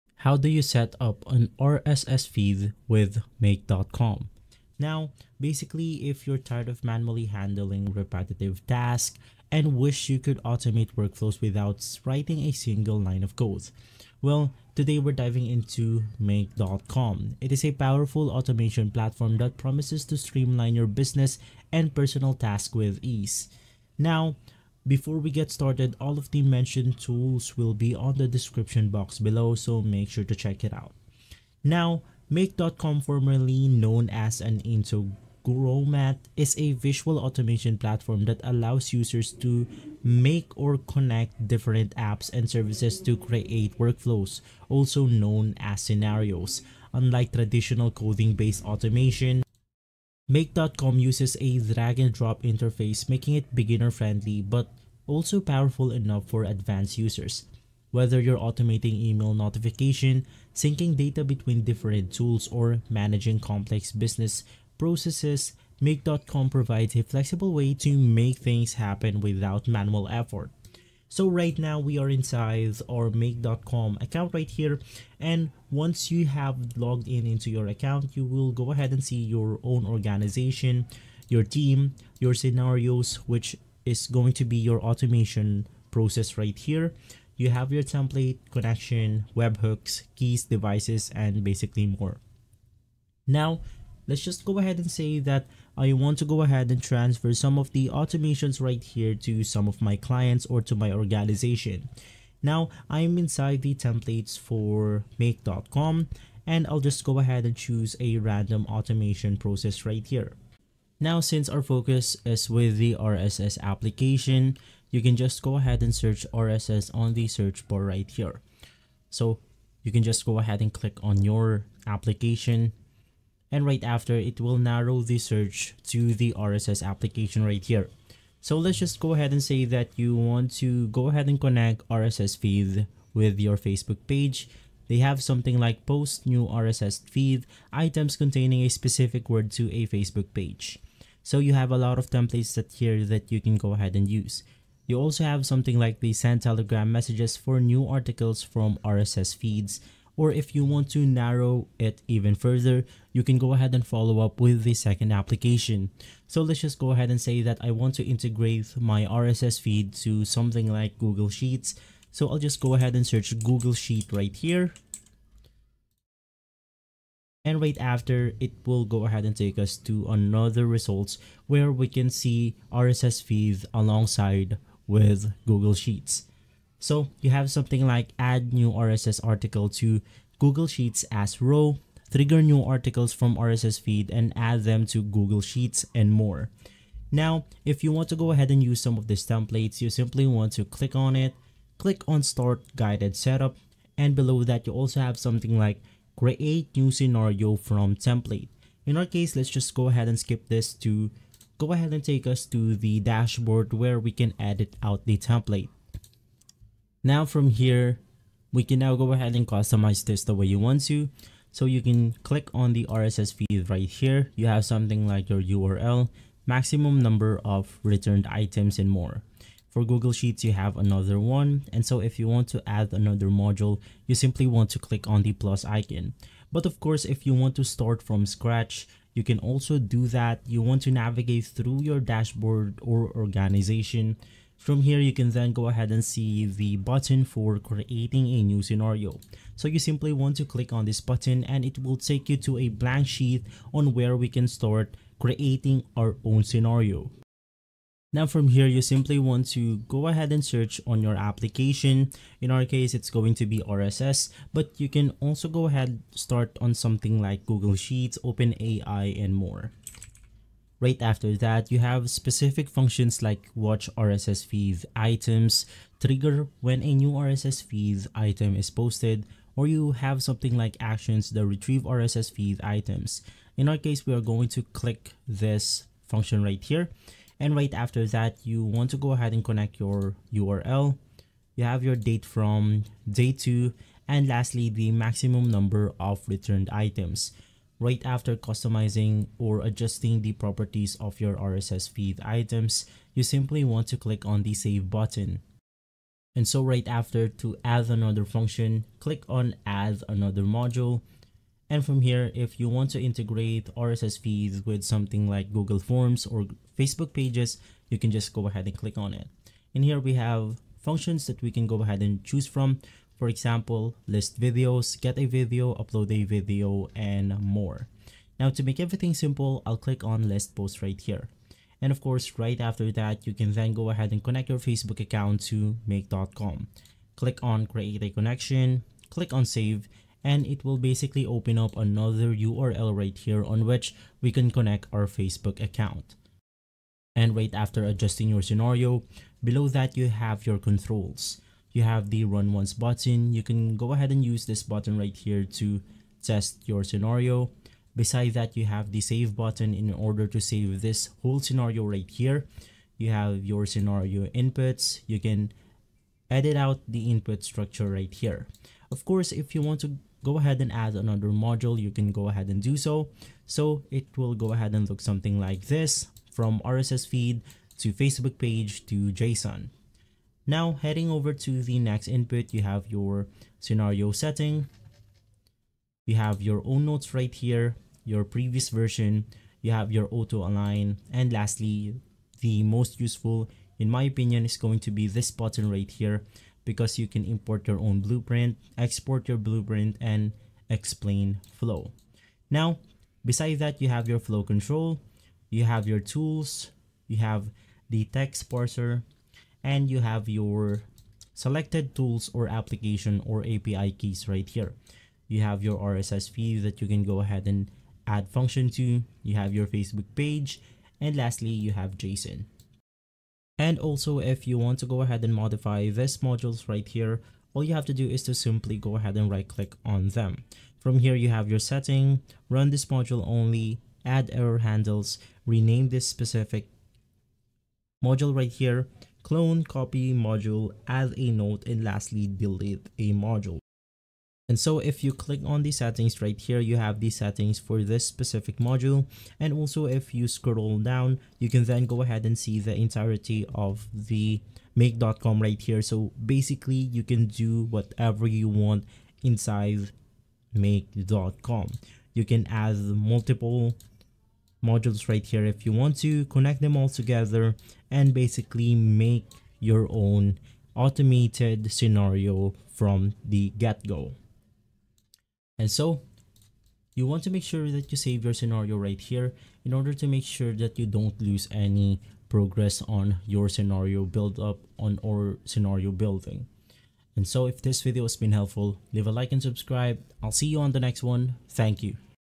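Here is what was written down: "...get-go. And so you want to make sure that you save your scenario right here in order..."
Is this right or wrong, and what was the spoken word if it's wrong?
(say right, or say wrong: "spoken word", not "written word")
right.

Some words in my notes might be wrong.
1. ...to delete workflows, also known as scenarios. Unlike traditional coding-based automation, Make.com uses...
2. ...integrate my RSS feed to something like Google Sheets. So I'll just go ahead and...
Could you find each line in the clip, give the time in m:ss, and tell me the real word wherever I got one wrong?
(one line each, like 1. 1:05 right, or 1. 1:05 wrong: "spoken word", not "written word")
1. 0:43 wrong: "create", not "delete"
2. 2:38 right.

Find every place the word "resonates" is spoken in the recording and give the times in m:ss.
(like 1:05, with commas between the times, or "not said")
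not said.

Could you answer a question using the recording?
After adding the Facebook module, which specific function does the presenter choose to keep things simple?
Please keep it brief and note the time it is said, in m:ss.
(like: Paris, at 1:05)
list post, at 5:20.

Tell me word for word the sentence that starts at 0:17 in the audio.
It is a powerful automation platform that promises to streamline your business and personal tasks with ease.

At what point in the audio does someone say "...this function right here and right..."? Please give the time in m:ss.
4:35.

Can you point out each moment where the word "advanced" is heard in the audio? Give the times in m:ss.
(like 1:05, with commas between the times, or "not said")
0:56.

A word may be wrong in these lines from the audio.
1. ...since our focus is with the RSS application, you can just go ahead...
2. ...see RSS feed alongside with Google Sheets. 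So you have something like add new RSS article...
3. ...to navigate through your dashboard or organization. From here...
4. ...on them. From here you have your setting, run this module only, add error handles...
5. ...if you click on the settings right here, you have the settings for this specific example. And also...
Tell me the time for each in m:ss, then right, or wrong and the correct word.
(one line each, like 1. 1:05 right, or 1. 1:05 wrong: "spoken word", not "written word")
1. 1:51 right
2. 2:52 right
3. 3:50 right
4. 6:59 right
5. 7:14 wrong: "module", not "example".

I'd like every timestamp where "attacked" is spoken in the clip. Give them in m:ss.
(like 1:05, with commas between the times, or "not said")
not said.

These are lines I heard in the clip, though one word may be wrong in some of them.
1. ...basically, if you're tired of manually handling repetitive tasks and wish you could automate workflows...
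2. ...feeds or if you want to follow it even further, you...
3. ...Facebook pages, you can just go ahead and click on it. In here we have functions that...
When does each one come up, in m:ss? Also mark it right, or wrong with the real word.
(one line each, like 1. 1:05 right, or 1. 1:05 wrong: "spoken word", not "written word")
1. 0:05 right
2. 2:29 wrong: "narrow", not "follow"
3. 5:06 right.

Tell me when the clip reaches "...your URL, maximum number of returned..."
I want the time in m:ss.
3:35.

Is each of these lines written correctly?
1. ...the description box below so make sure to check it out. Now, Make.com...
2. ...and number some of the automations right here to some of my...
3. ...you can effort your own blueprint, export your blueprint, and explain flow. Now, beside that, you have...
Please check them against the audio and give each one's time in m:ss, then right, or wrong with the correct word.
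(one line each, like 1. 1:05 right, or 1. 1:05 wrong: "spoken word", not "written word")
1. 0:28 right
2. 1:36 wrong: "transfer", not "number"
3. 6:26 wrong: "import", not "effort".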